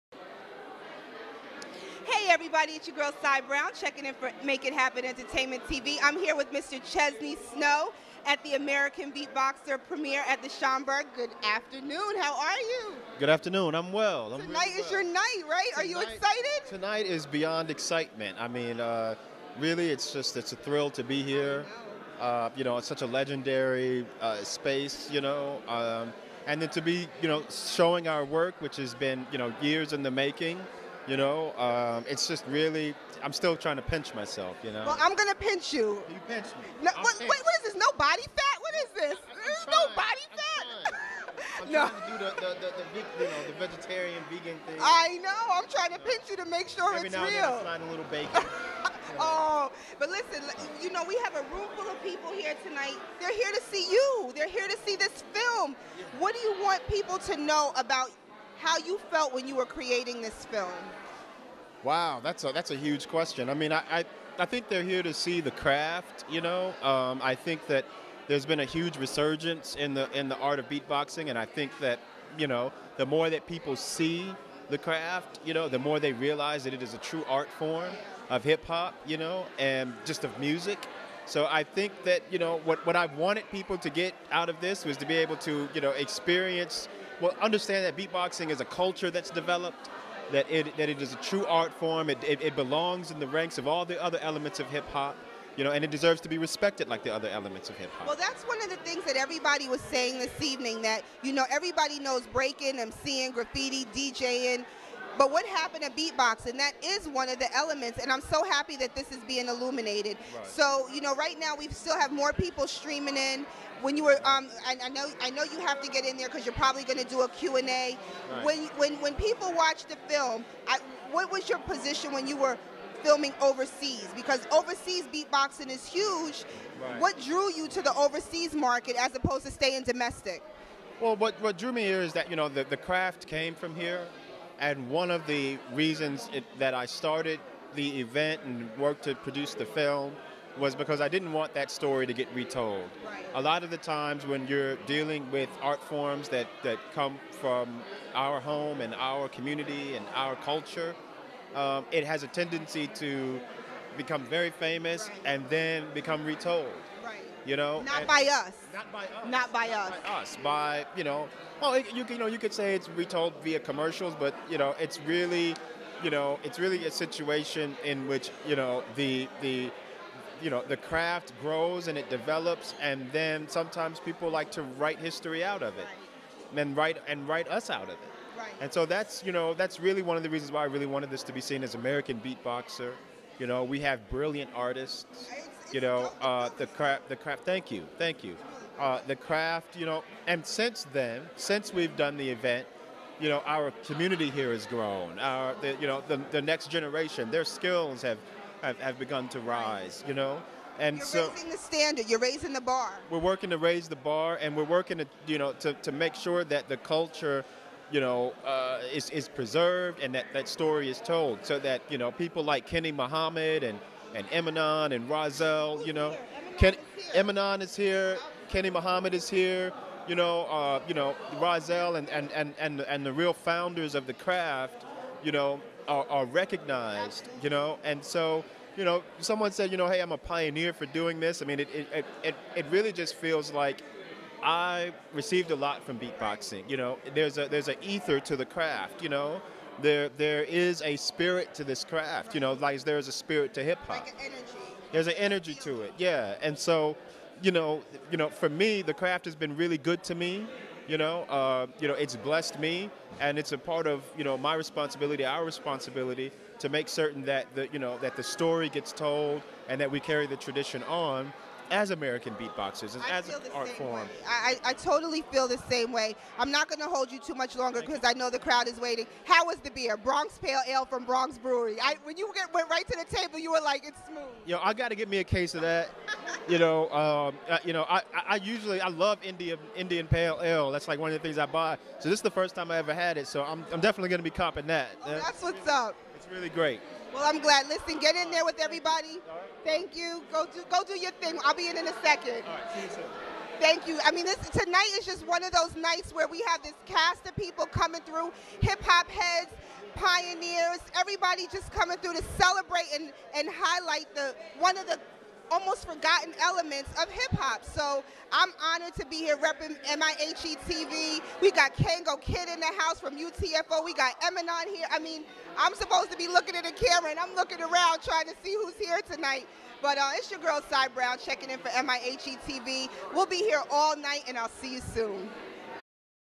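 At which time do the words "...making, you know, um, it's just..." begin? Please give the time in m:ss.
0:30.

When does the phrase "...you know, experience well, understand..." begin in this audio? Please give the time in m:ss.
1:25.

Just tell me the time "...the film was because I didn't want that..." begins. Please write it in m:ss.
2:19.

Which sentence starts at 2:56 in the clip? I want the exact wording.
and write and write us out of it right.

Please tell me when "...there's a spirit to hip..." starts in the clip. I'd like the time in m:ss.
4:02.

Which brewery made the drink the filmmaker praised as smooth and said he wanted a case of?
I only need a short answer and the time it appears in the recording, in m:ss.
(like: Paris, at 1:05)
Bronx Brewery, at 4:31.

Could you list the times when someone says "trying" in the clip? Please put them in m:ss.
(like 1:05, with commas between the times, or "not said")
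0:33, 0:41, 0:45, 5:18.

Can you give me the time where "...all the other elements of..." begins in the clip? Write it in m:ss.
1:33.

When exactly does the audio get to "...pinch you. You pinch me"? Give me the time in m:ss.
0:35.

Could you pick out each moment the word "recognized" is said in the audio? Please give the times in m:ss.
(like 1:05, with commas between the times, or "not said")
3:46.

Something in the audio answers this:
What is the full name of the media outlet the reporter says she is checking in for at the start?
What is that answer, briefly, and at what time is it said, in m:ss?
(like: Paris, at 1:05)
Make It Happen Entertainment TV, at 0:04.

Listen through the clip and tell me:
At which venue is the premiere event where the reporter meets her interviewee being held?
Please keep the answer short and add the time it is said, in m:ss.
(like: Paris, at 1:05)
The Schomburg, at 0:10.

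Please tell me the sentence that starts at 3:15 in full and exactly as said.
Our, the, you know, the, the next generation, their skills have, have, have begun to rise.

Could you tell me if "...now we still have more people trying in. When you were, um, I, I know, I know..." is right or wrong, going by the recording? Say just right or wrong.
wrong.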